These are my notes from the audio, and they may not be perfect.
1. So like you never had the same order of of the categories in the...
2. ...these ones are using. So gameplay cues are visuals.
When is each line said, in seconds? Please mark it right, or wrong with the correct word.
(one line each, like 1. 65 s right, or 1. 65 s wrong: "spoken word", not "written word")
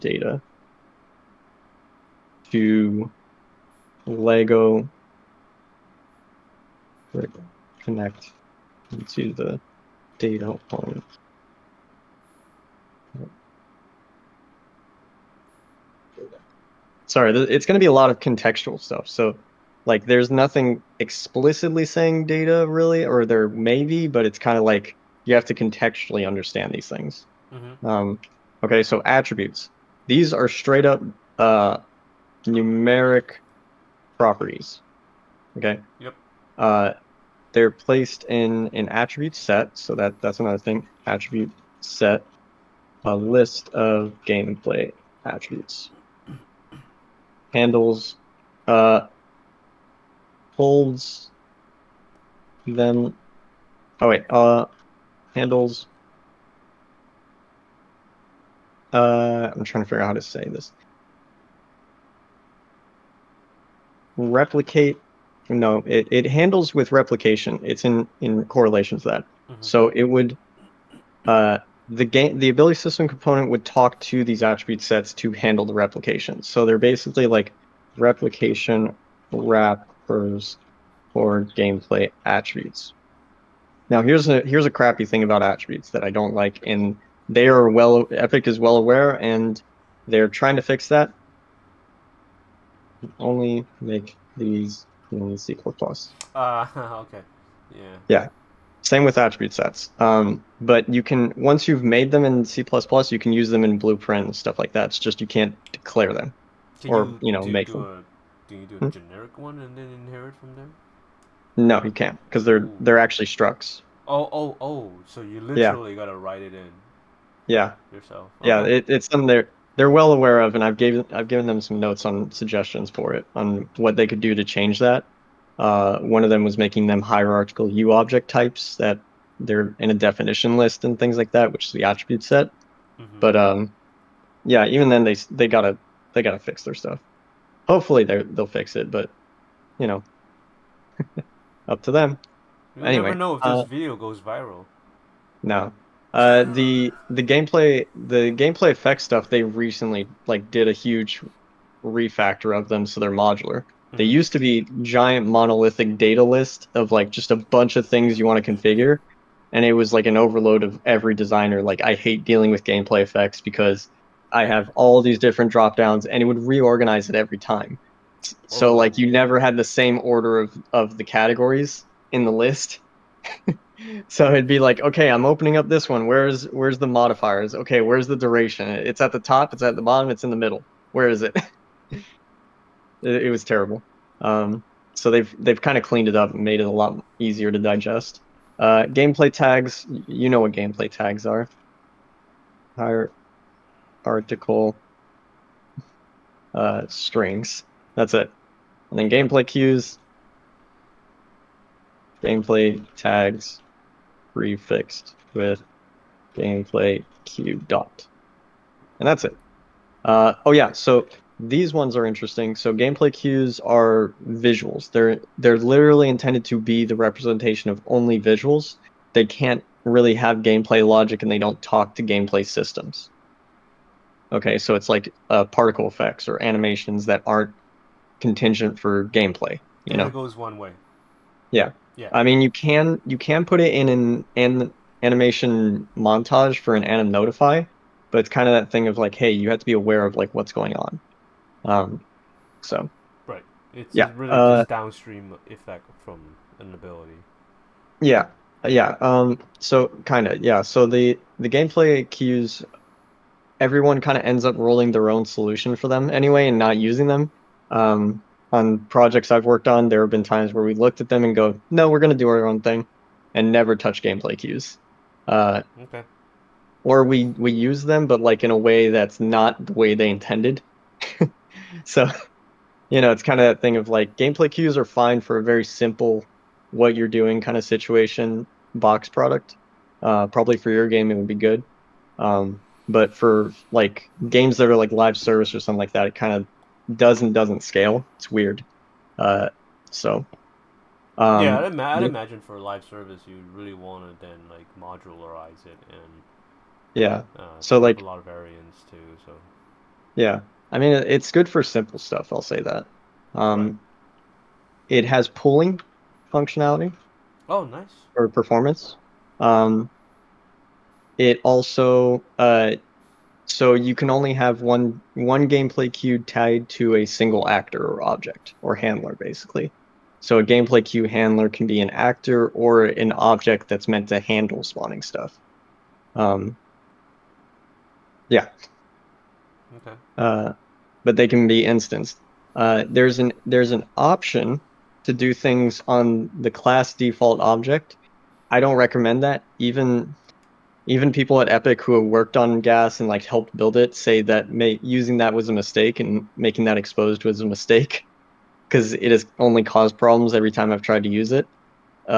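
1. 168 s right
2. 211 s wrong: "interesting", not "using".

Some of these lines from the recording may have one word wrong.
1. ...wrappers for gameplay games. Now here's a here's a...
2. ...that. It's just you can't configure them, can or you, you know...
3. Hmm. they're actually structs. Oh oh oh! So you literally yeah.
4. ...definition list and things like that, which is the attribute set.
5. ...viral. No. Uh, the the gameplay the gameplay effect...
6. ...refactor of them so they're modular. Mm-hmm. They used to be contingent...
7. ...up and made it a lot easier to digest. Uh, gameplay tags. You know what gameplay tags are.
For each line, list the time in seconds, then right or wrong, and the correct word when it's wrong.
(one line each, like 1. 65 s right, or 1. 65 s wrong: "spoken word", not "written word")
1. 79 s wrong: "attributes", not "games"
2. 104 s wrong: "declare", not "configure"
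3. 112 s right
4. 129 s right
5. 144 s right
6. 151 s wrong: "giant", not "contingent"
7. 186 s right.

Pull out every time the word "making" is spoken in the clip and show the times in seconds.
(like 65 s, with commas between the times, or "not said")
126 s, 346 s.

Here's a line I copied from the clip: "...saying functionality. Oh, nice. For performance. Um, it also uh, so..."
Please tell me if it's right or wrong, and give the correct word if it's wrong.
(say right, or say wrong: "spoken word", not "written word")
wrong: "pooling", not "saying".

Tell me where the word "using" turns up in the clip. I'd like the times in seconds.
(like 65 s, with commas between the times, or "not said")
256 s, 344 s.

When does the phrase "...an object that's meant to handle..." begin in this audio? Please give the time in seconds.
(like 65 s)
322 s.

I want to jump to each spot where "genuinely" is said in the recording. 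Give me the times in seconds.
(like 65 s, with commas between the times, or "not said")
not said.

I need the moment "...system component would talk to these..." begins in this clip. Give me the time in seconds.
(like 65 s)
72 s.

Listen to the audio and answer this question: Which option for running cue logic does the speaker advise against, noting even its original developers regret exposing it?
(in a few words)
Class default object.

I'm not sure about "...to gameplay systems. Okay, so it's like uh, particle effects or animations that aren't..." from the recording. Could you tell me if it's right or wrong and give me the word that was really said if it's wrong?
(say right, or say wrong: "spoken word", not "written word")
right.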